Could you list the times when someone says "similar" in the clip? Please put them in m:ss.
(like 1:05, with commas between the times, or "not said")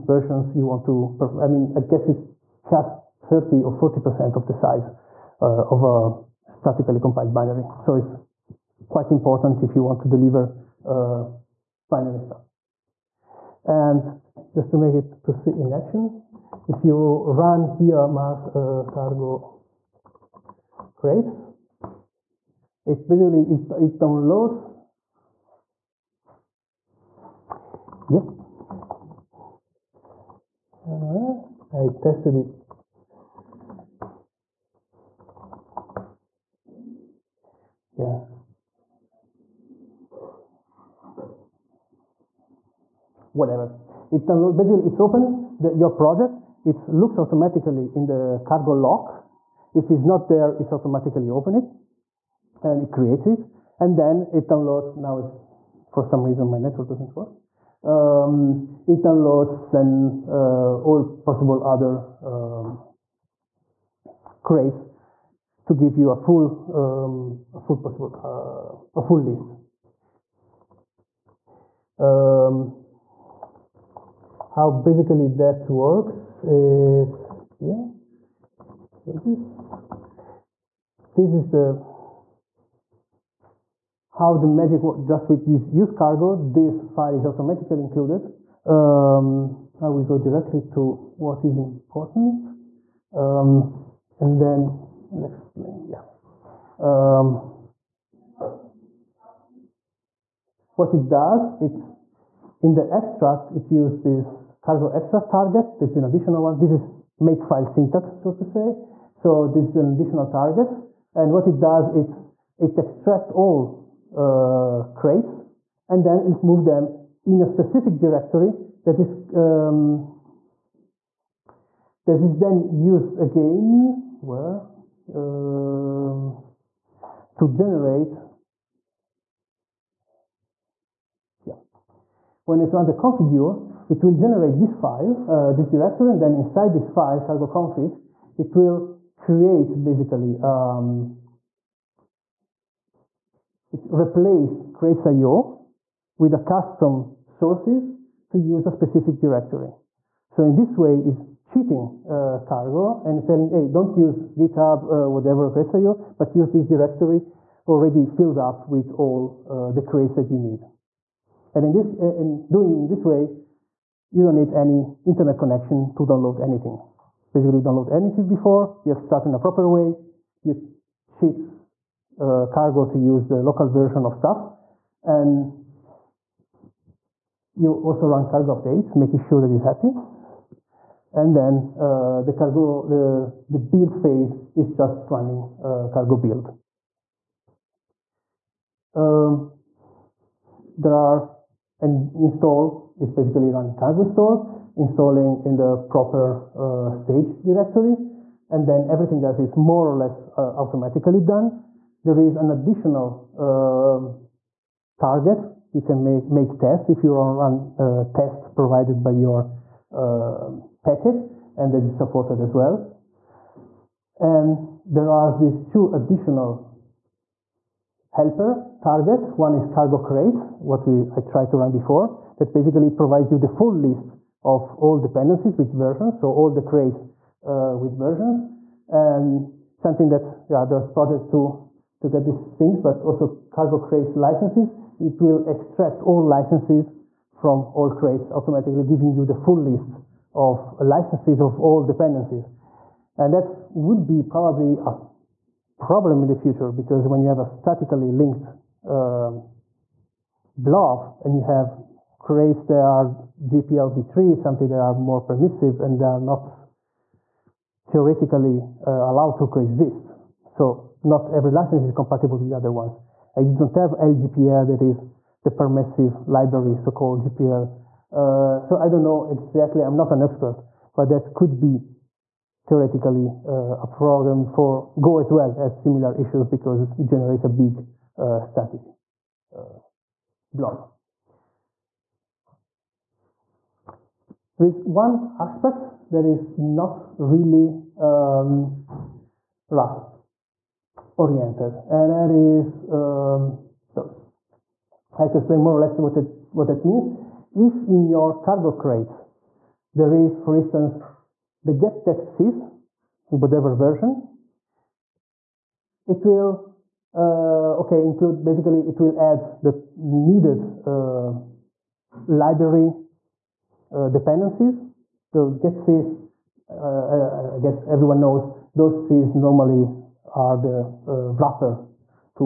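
4:35.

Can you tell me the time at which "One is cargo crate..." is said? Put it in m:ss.
3:39.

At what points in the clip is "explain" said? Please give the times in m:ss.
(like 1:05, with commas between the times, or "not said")
1:35, 4:55.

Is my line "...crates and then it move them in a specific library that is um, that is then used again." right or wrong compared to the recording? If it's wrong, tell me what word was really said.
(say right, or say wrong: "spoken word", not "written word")
wrong: "directory", not "library".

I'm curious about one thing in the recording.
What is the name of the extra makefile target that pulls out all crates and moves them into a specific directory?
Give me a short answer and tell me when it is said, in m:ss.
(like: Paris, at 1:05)
cargo extract, at 1:44.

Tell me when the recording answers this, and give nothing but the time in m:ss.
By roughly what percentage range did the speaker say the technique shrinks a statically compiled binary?
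0:03.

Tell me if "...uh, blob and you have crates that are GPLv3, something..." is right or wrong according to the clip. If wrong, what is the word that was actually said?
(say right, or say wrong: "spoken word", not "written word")
right.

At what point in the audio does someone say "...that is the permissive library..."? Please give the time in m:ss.
4:24.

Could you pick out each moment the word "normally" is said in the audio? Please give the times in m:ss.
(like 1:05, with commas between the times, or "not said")
5:19.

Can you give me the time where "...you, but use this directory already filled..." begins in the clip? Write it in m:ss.
2:35.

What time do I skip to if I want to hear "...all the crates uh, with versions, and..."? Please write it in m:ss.
3:46.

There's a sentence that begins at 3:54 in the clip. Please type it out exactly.
It will extract all licenses from all crates automatically, giving you the full list of licenses of all dependencies.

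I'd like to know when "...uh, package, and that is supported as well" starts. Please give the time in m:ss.
3:29.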